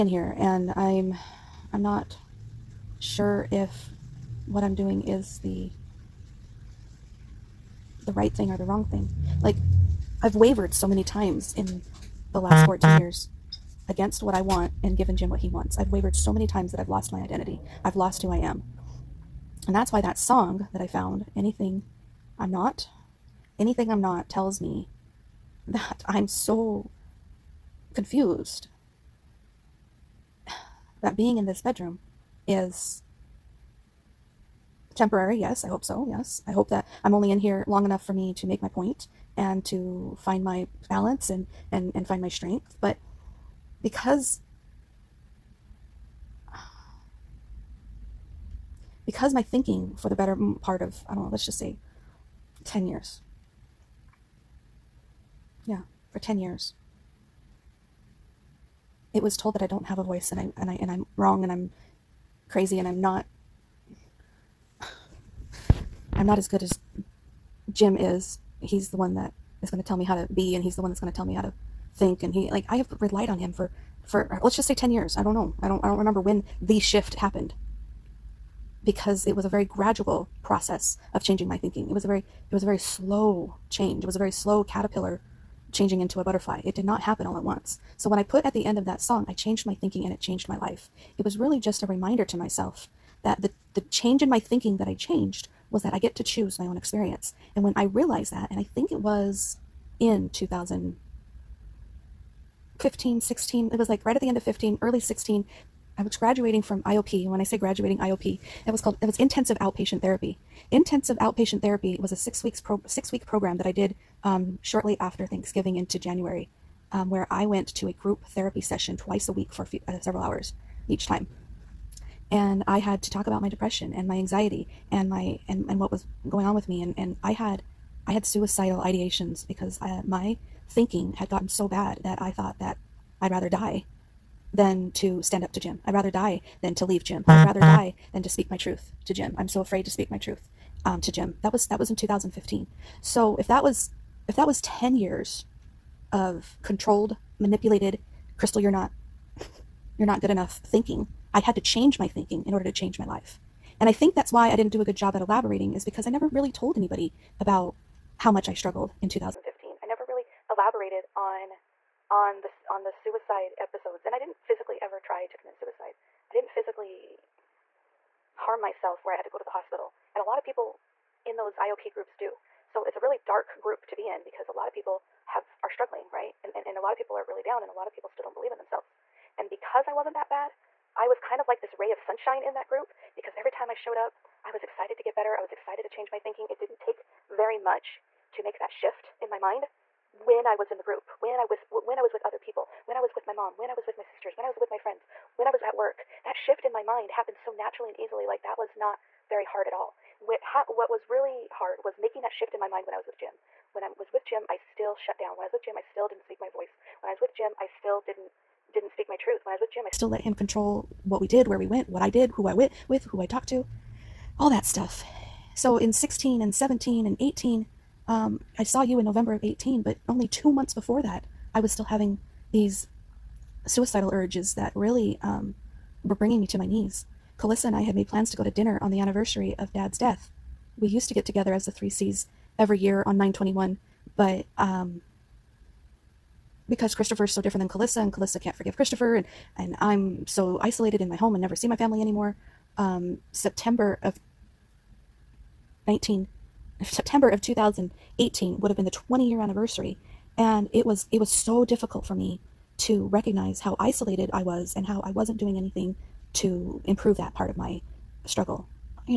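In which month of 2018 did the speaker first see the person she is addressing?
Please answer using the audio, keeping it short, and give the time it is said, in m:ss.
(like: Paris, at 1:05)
November, at 3:39.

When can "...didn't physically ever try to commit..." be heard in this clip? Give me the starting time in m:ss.
2:44.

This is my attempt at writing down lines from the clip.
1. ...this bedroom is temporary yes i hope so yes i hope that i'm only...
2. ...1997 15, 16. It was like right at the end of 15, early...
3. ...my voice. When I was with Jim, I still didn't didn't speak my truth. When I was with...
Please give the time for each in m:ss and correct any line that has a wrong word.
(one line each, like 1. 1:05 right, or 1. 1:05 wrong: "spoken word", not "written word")
1. 0:31 right
2. 1:40 wrong: "2000", not "1997"
3. 3:26 right.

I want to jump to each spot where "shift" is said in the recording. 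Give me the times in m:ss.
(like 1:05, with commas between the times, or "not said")
1:16, 3:08, 3:16, 3:22.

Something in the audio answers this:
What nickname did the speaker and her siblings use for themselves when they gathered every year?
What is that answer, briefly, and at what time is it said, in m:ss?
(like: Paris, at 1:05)
the three C's, at 3:51.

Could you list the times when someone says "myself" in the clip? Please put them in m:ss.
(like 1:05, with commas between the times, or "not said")
1:32, 2:48.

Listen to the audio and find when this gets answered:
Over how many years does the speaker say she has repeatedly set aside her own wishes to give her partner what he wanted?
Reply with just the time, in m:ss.
0:12.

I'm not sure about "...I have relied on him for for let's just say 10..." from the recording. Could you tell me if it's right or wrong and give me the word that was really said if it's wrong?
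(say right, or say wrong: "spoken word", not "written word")
right.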